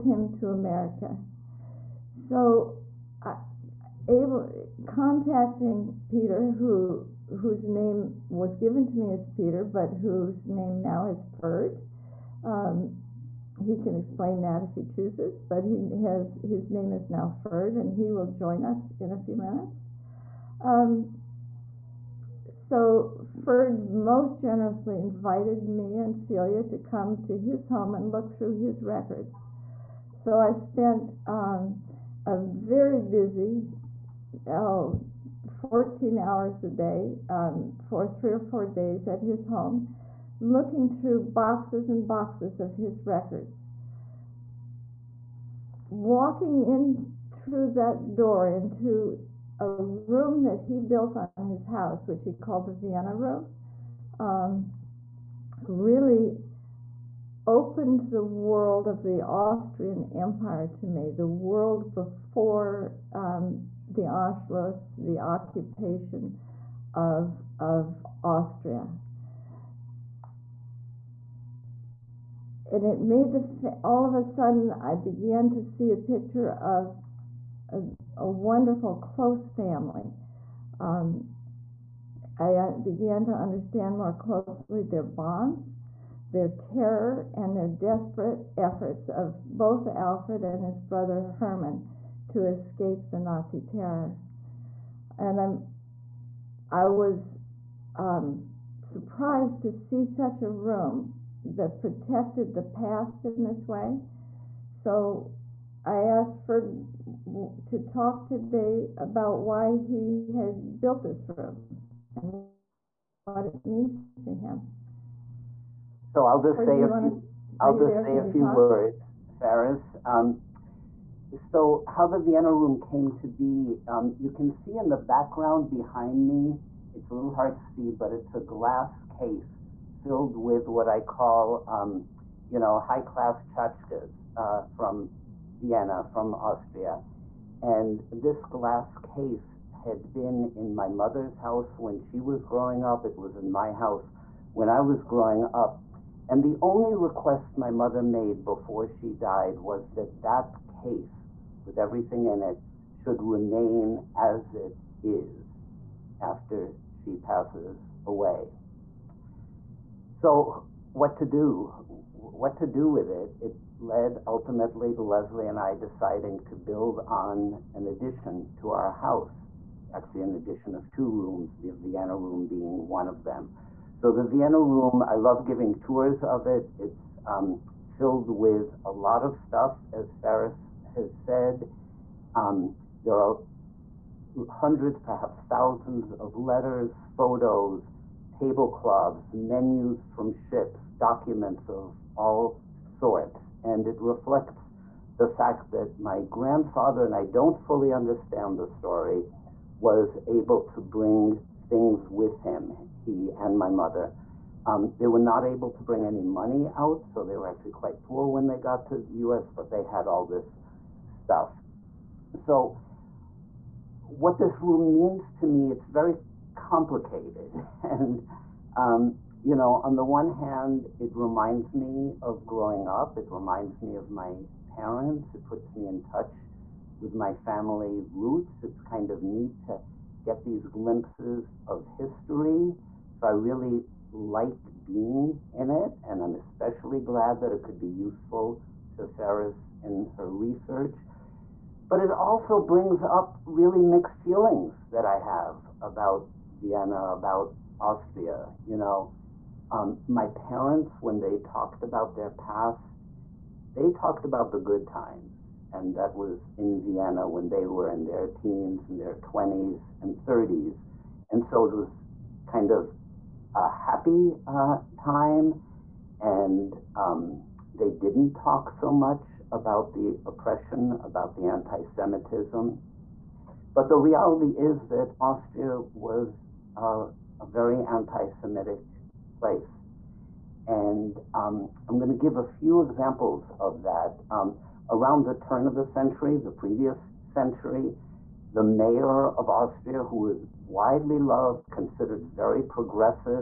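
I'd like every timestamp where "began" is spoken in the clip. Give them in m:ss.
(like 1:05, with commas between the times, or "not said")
1:14, 1:22.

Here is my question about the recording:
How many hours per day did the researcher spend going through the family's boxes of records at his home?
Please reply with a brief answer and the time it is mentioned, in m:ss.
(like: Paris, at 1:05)
14, at 0:35.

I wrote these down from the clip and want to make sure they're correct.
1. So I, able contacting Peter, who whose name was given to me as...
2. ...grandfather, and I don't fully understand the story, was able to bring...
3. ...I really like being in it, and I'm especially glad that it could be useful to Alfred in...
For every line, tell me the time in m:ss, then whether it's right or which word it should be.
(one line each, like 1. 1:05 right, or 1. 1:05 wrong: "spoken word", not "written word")
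1. 0:02 right
2. 3:16 right
3. 3:53 wrong: "Faris", not "Alfred".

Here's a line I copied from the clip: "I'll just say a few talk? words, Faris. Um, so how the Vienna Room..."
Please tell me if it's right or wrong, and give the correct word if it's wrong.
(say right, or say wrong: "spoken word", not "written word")
right.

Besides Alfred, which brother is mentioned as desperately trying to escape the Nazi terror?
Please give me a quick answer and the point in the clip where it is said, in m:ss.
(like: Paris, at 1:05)
Herman, at 1:31.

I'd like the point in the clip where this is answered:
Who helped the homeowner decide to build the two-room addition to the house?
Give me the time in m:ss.
2:45.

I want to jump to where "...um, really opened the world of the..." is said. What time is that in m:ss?
0:54.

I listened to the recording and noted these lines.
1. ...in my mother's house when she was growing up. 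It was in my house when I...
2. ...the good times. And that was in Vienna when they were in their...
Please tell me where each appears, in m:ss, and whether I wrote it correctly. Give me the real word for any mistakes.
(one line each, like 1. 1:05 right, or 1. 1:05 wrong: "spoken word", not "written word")
1. 2:20 right
2. 4:14 right.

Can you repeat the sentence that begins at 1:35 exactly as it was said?
And I'm, I was um, surprised to see such a room that protected the past in this way.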